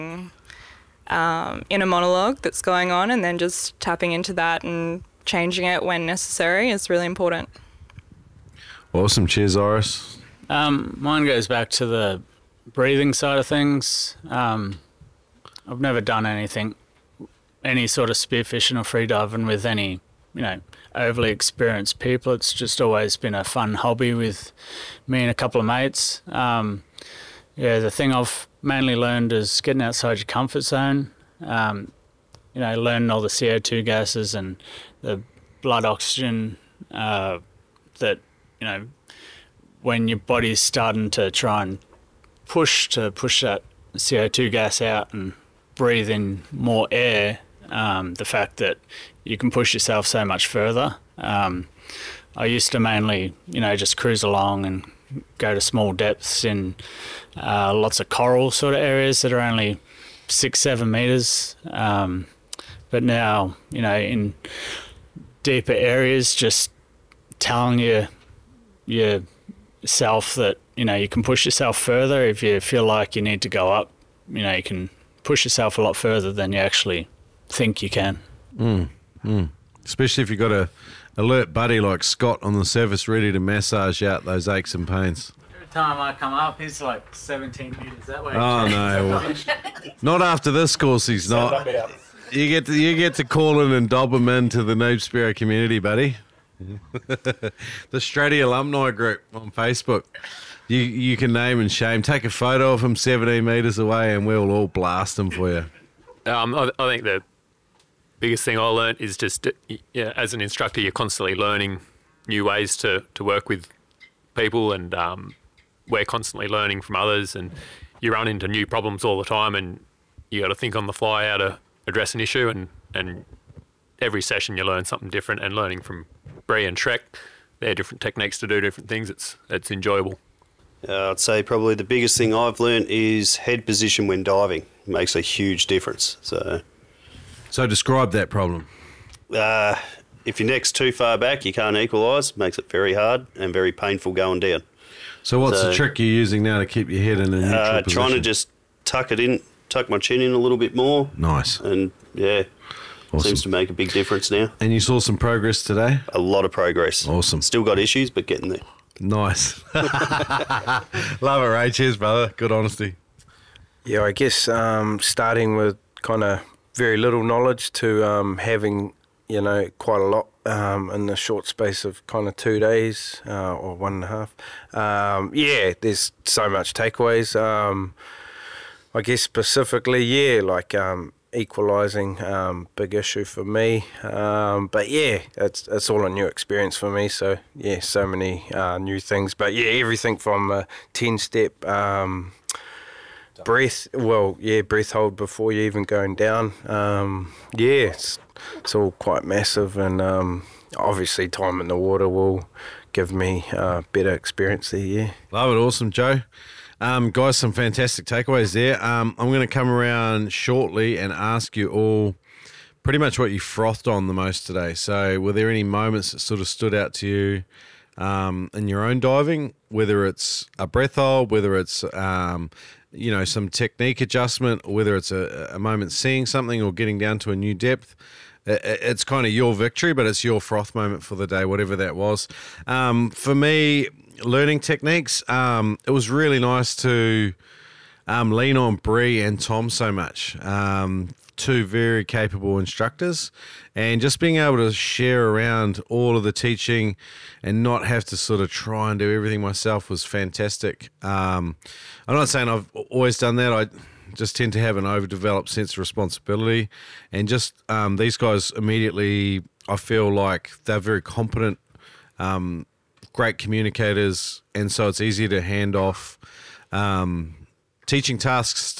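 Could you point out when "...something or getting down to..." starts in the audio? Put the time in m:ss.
3:46.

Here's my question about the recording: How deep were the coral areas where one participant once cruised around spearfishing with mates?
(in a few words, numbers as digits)
6-7 metres.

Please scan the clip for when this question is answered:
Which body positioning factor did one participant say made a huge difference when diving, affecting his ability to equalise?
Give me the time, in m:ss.
2:13.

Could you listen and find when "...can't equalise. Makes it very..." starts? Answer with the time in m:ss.
2:21.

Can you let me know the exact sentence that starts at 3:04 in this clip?
Um, but yeah, it's it's all a new experience for me.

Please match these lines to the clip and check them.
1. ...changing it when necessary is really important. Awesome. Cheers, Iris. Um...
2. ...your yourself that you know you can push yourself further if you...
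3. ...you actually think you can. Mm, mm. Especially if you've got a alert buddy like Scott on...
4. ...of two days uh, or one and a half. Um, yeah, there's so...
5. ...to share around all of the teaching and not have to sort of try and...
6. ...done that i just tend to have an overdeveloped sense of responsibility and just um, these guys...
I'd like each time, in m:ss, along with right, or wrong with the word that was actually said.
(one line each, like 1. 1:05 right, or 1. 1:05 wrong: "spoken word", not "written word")
1. 0:05 right
2. 1:07 right
3. 1:16 right
4. 2:52 right
5. 4:04 right
6. 4:13 right.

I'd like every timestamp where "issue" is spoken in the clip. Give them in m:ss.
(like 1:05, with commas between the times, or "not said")
2:02, 2:37, 3:02.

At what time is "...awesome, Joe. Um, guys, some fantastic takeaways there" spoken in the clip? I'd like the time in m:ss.
3:25.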